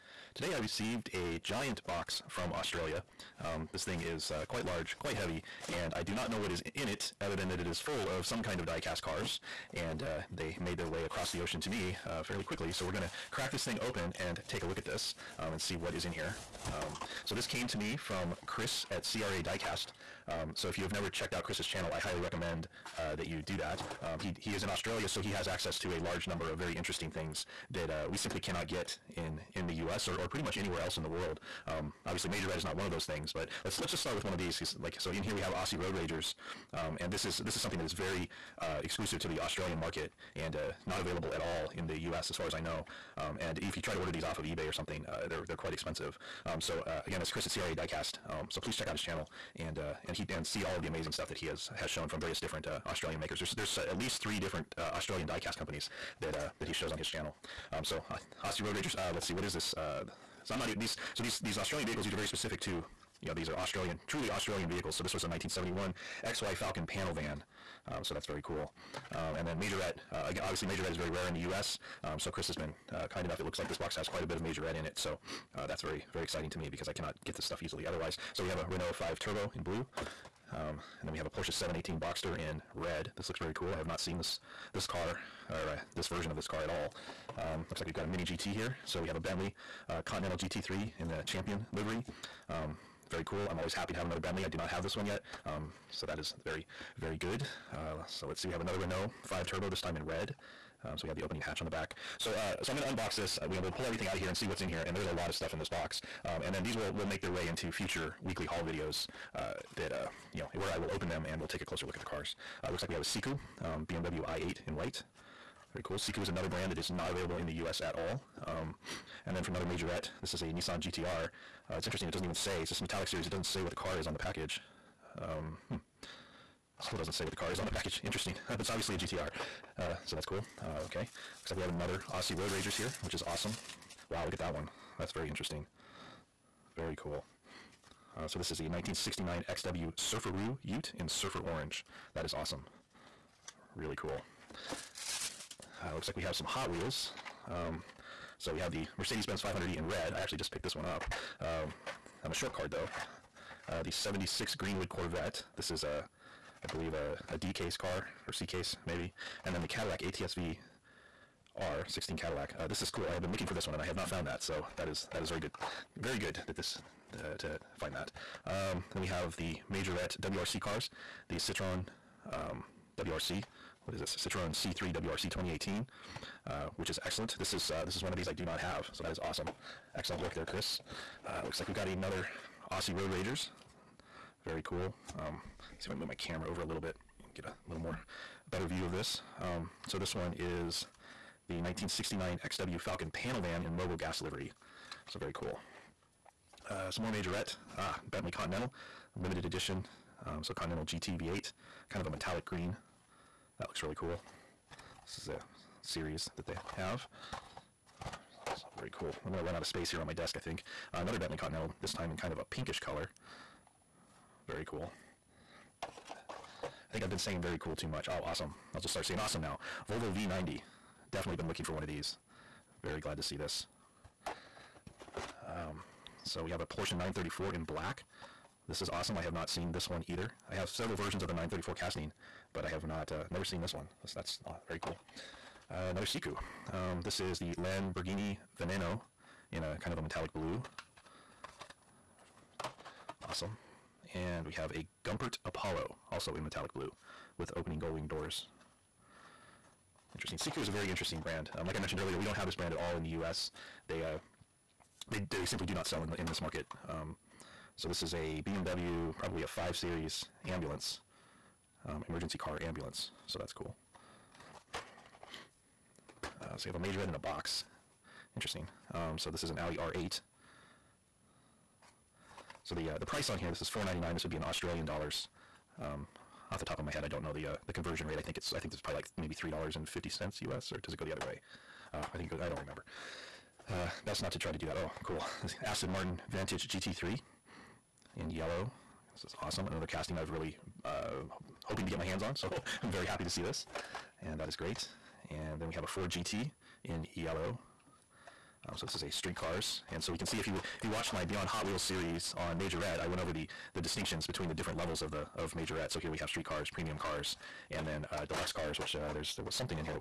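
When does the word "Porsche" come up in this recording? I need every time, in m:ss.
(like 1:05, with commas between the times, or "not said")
1:21, 3:46.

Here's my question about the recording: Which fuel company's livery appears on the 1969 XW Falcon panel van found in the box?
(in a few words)
Mobil.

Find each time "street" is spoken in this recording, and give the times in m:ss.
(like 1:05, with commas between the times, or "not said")
4:59, 5:06.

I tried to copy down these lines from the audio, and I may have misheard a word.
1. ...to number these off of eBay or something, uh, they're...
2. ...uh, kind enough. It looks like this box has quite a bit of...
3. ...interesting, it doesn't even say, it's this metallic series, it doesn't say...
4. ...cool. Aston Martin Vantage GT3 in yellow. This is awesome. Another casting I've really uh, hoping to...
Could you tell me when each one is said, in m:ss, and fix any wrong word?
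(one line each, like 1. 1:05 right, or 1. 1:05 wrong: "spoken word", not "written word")
1. 0:43 wrong: "order", not "number"
2. 1:12 right
3. 2:01 right
4. 4:45 right.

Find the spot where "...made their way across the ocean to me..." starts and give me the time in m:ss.
0:10.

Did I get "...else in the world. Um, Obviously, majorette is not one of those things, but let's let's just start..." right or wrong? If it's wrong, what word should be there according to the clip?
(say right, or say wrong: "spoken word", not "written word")
right.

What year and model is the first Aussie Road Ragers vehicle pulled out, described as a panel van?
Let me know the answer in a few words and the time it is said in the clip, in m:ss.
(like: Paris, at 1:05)
1971 XY Falcon, at 1:05.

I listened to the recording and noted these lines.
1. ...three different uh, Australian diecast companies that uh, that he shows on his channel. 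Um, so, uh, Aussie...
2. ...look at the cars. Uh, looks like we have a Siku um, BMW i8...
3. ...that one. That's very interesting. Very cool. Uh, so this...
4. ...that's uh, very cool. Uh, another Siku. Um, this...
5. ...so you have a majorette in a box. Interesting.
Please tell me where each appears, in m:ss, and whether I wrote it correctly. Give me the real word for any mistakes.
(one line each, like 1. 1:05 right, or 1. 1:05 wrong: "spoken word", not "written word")
1. 0:54 right
2. 1:51 right
3. 2:14 right
4. 3:54 right
5. 4:26 right.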